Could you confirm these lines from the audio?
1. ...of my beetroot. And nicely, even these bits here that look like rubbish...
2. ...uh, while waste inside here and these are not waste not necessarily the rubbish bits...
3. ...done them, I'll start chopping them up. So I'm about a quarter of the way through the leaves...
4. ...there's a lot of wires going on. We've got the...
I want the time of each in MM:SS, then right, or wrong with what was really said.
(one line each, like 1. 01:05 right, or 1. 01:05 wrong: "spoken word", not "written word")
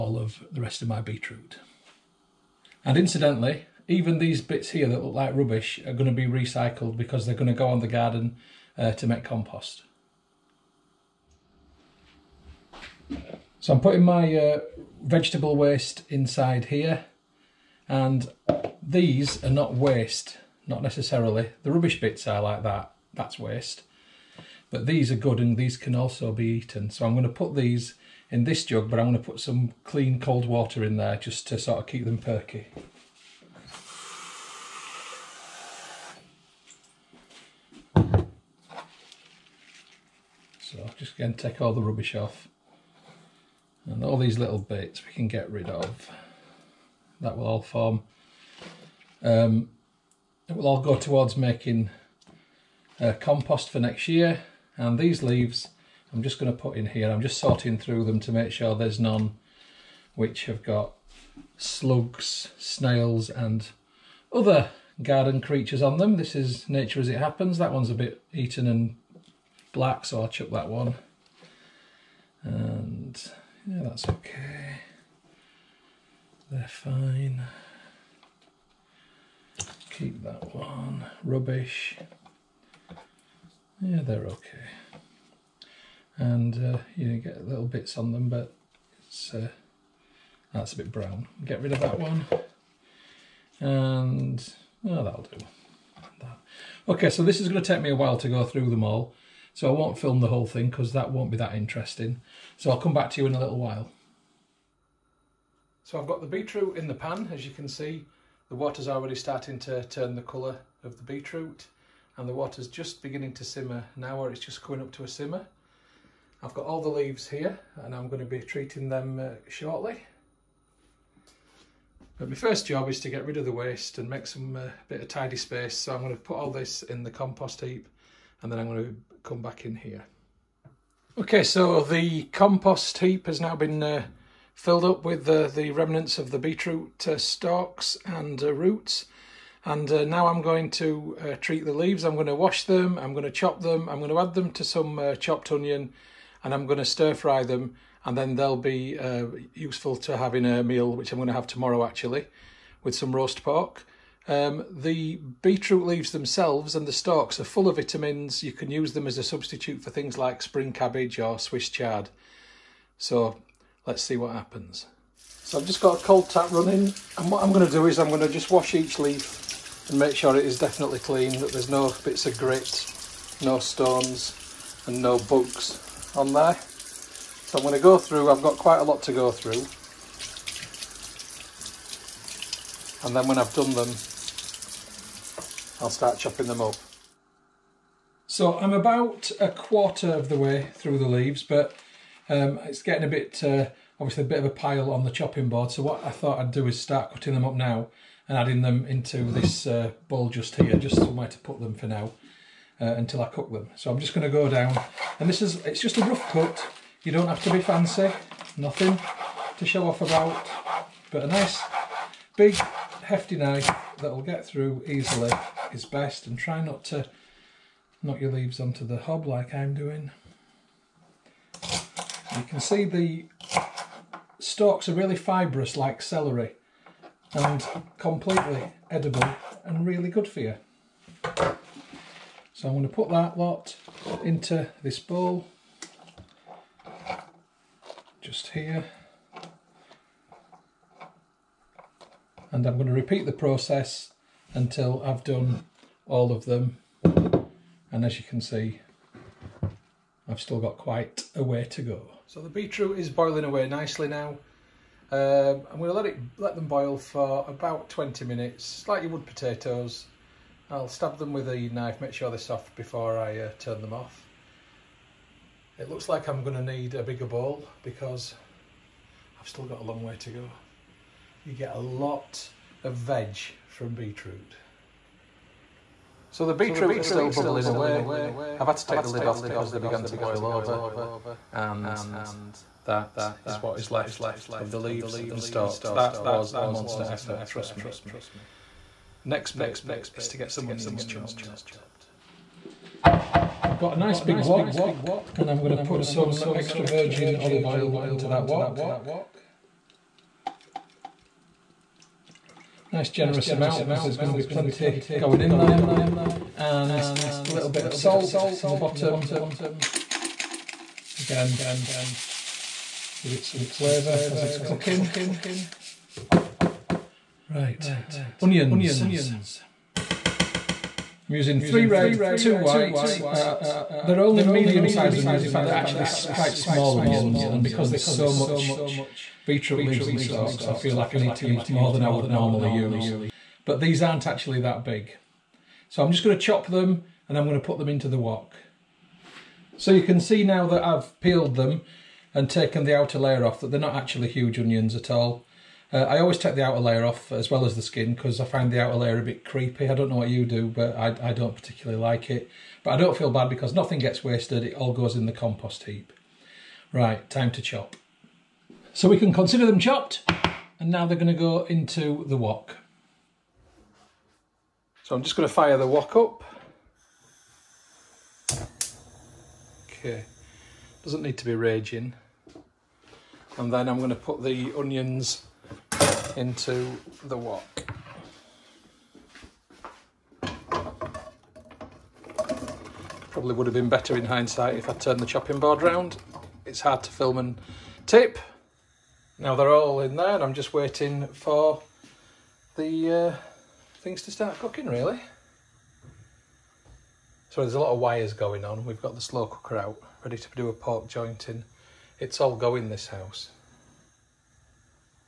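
1. 00:00 wrong: "incidentally", not "nicely"
2. 00:14 wrong: "vegetable", not "while"
3. 03:03 right
4. 06:37 right.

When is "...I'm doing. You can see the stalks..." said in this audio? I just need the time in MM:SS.
03:39.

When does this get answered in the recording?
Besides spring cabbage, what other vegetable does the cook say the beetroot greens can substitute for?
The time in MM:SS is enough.
02:41.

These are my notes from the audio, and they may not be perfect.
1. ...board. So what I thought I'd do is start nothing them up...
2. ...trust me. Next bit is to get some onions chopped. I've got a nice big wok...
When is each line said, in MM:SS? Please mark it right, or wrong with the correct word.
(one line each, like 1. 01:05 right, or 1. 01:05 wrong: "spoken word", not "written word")
1. 03:15 wrong: "cutting", not "nothing"
2. 04:47 right.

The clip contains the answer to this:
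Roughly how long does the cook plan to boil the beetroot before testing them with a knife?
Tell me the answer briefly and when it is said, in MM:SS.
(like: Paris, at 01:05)
20 minutes, at 04:17.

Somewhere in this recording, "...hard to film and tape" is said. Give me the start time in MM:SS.
06:26.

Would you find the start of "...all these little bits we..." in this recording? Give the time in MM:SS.
00:44.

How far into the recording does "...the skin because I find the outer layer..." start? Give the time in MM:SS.
05:47.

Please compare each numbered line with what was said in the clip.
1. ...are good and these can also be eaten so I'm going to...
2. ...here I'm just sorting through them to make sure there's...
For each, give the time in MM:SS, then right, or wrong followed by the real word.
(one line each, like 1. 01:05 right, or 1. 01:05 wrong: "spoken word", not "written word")
1. 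00:25 right
2. 00:56 right.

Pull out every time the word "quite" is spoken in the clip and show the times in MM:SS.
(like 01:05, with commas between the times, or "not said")
02:58, 04:10, 05:26.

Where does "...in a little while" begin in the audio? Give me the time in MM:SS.
01:43.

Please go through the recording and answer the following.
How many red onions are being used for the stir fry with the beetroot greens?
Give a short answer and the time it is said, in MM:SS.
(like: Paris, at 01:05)
3, at 05:21.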